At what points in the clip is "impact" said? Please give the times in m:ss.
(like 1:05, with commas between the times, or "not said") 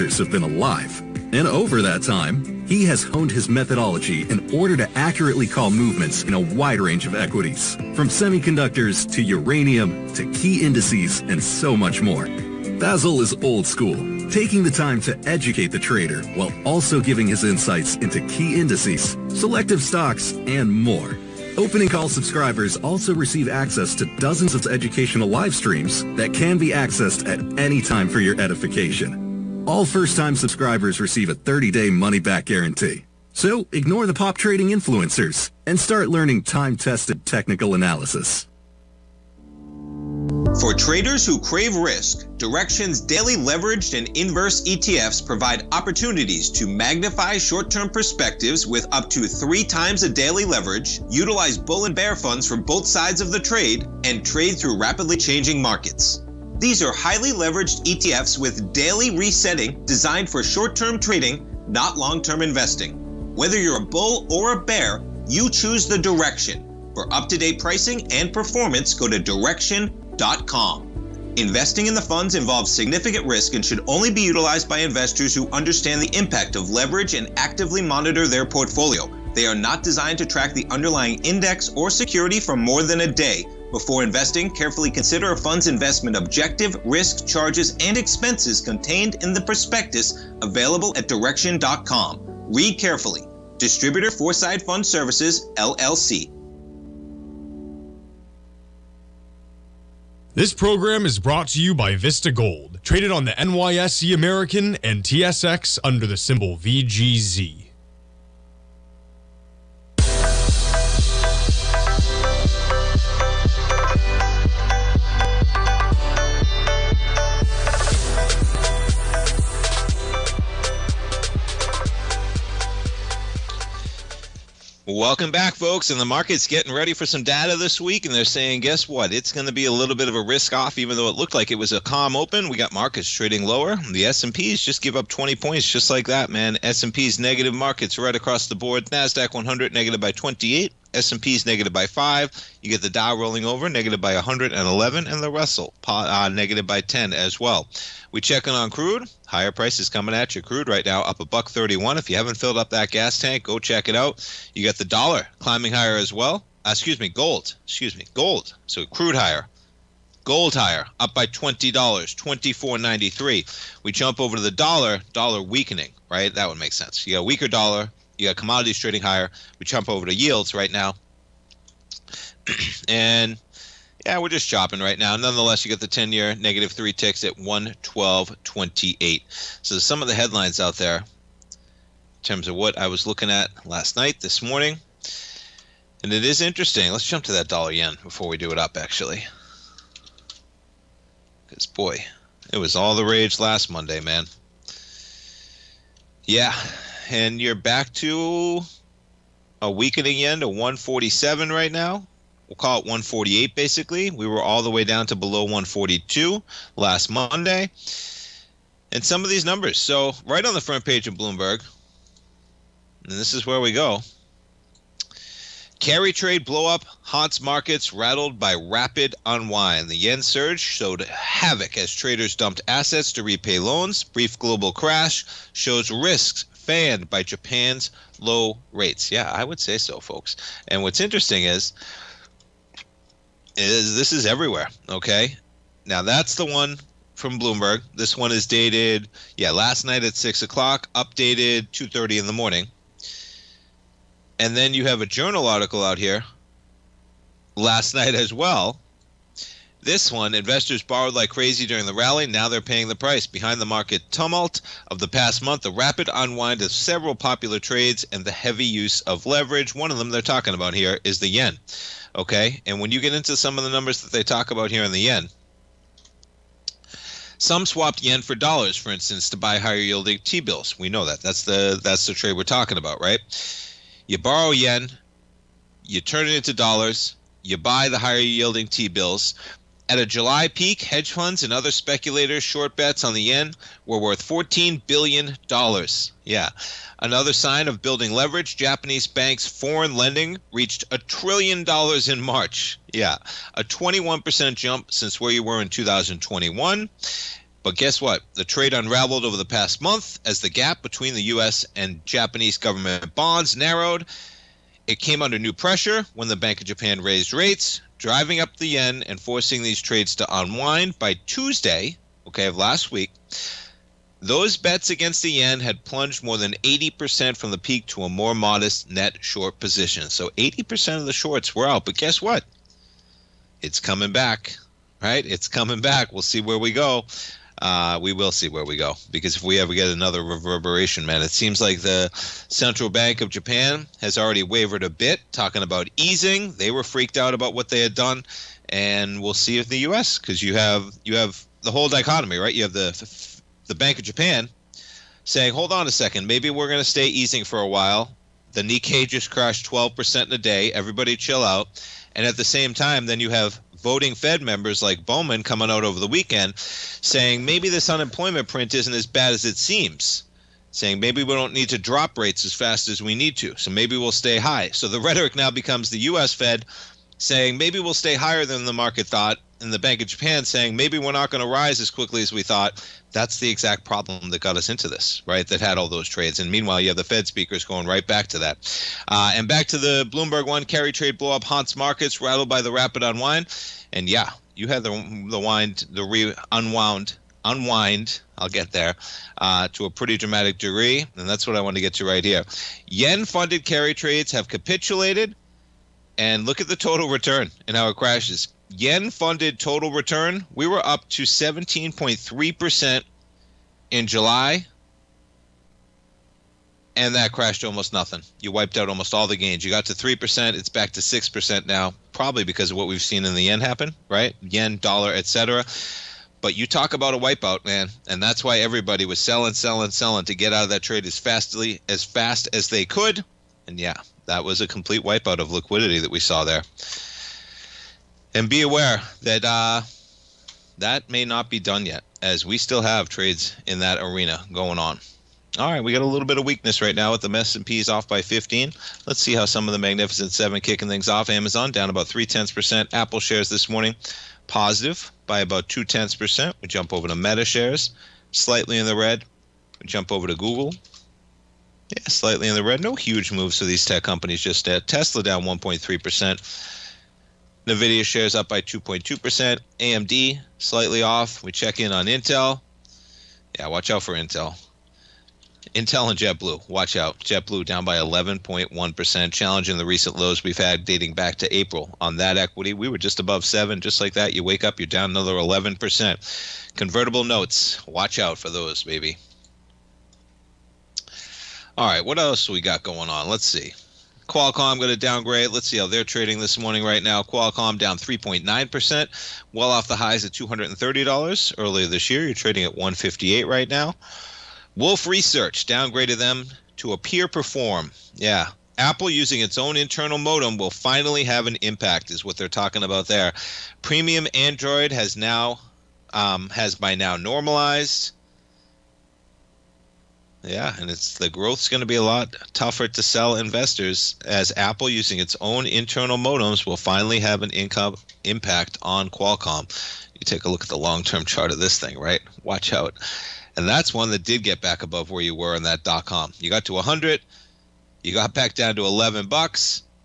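1:16, 8:21, 8:38.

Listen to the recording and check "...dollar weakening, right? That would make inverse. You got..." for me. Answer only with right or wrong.
wrong.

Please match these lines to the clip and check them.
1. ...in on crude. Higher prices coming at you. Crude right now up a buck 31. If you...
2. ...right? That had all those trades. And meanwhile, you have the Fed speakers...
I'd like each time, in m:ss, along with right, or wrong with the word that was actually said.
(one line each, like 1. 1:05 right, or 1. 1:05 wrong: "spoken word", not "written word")
1. 2:28 right
2. 6:15 right.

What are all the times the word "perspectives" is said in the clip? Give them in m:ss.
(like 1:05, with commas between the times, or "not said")
0:47.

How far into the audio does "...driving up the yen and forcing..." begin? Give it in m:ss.
5:07.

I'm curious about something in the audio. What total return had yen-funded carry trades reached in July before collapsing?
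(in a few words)
17.3%.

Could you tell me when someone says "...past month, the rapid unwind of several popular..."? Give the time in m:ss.
4:15.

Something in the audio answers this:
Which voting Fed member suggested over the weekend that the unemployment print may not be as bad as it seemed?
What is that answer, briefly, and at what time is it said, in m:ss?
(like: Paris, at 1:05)
Bowman, at 5:55.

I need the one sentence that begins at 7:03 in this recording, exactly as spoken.
And yeah, that was a complete wipeout of liquidity that we saw there.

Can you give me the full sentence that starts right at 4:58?
The trade unraveled over the past month as the gap between the U.S.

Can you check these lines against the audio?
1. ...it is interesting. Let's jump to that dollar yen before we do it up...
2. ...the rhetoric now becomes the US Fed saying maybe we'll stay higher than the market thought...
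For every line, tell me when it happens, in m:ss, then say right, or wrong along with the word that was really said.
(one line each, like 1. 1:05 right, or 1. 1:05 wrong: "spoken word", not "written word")
1. 3:06 right
2. 6:04 right.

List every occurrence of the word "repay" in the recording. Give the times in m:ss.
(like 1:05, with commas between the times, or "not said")
3:43.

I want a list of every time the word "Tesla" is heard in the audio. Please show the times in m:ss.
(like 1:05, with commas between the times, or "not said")
7:34.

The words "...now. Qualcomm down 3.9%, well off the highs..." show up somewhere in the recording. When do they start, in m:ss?
8:07.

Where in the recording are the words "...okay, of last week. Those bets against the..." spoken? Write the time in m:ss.
5:12.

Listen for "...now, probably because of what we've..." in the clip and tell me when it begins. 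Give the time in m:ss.
6:51.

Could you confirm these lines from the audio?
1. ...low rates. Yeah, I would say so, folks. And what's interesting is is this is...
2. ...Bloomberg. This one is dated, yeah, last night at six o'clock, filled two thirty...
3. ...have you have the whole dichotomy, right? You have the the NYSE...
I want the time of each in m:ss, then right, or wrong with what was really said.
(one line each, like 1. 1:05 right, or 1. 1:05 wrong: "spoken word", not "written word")
1. 3:48 right
2. 3:57 wrong: "updated", not "filled"
3. 5:40 wrong: "Bank", not "NYSE".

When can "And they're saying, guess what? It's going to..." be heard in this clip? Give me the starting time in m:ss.
2:08.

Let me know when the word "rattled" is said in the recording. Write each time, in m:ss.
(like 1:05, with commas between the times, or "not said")
3:37, 6:22.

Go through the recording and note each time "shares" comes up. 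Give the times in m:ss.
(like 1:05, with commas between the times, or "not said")
7:23, 7:27, 7:38.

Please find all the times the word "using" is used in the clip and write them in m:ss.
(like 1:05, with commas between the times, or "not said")
8:19, 8:34.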